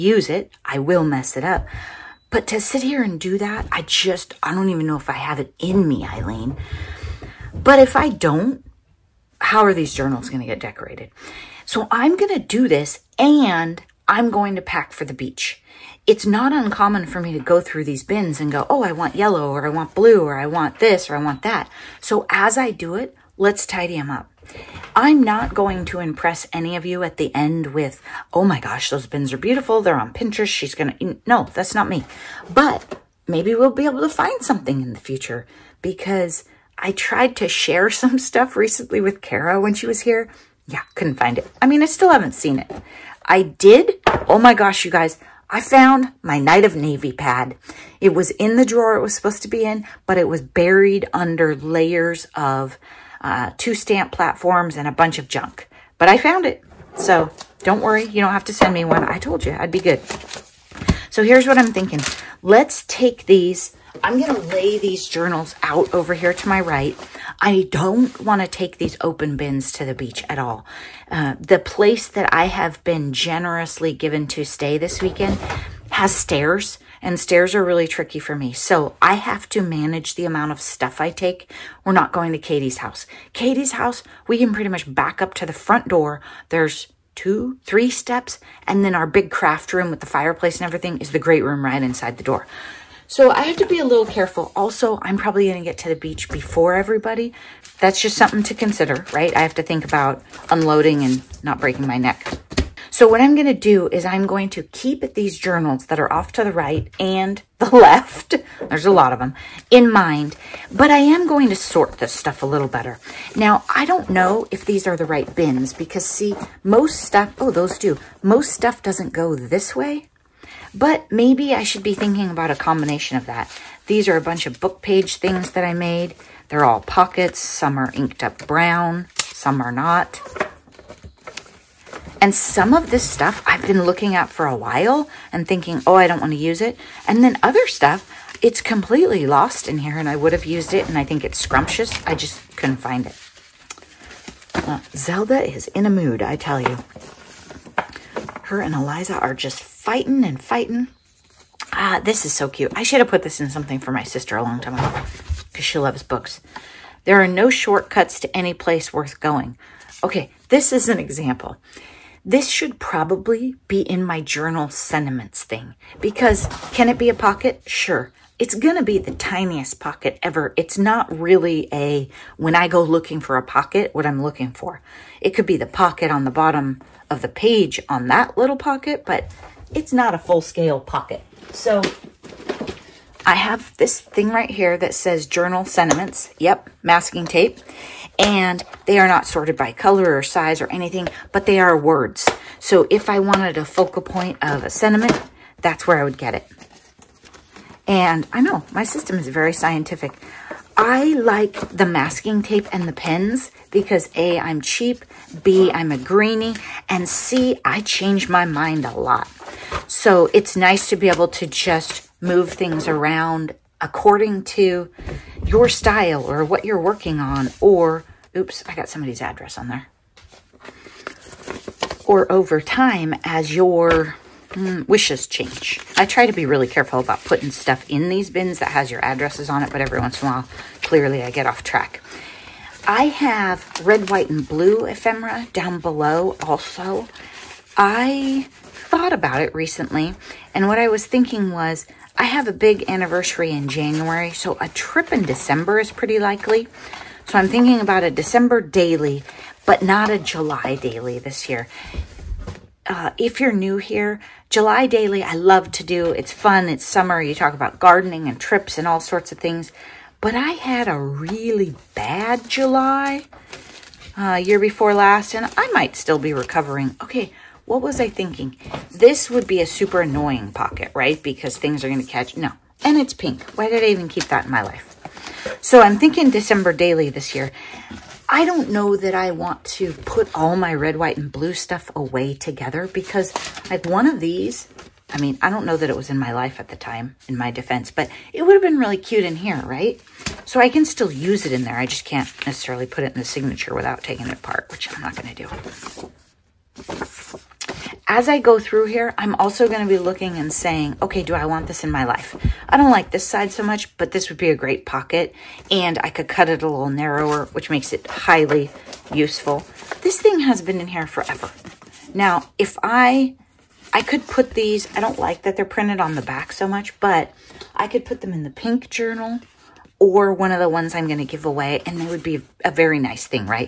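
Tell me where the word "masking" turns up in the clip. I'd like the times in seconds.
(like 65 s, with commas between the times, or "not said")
186 s, 201 s.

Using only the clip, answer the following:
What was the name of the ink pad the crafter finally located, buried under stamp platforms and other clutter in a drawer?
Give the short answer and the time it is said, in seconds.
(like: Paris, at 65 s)
Night of Navy, at 46 s.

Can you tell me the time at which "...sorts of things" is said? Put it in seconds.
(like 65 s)
258 s.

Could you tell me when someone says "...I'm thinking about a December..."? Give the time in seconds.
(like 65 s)
247 s.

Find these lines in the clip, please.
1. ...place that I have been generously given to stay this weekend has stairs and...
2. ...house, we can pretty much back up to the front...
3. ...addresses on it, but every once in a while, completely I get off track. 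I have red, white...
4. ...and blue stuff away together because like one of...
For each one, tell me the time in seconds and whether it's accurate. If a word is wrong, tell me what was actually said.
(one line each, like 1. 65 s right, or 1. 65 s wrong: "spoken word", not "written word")
1. 71 s right
2. 83 s right
3. 229 s wrong: "clearly", not "completely"
4. 281 s right.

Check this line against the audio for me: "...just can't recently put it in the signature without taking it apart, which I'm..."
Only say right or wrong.
wrong.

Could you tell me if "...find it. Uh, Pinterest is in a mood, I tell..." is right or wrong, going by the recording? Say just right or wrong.
wrong.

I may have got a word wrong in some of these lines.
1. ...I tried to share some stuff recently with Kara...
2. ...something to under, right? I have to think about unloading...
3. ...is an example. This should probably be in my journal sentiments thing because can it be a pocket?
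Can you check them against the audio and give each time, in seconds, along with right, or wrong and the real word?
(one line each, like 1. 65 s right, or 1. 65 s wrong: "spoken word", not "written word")
1. 36 s right
2. 98 s wrong: "consider", not "under"
3. 160 s right.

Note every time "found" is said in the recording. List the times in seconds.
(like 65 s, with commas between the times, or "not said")
45 s, 56 s.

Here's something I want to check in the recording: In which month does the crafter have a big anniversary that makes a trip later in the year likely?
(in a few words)
January.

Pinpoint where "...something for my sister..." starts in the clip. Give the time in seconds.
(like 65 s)
153 s.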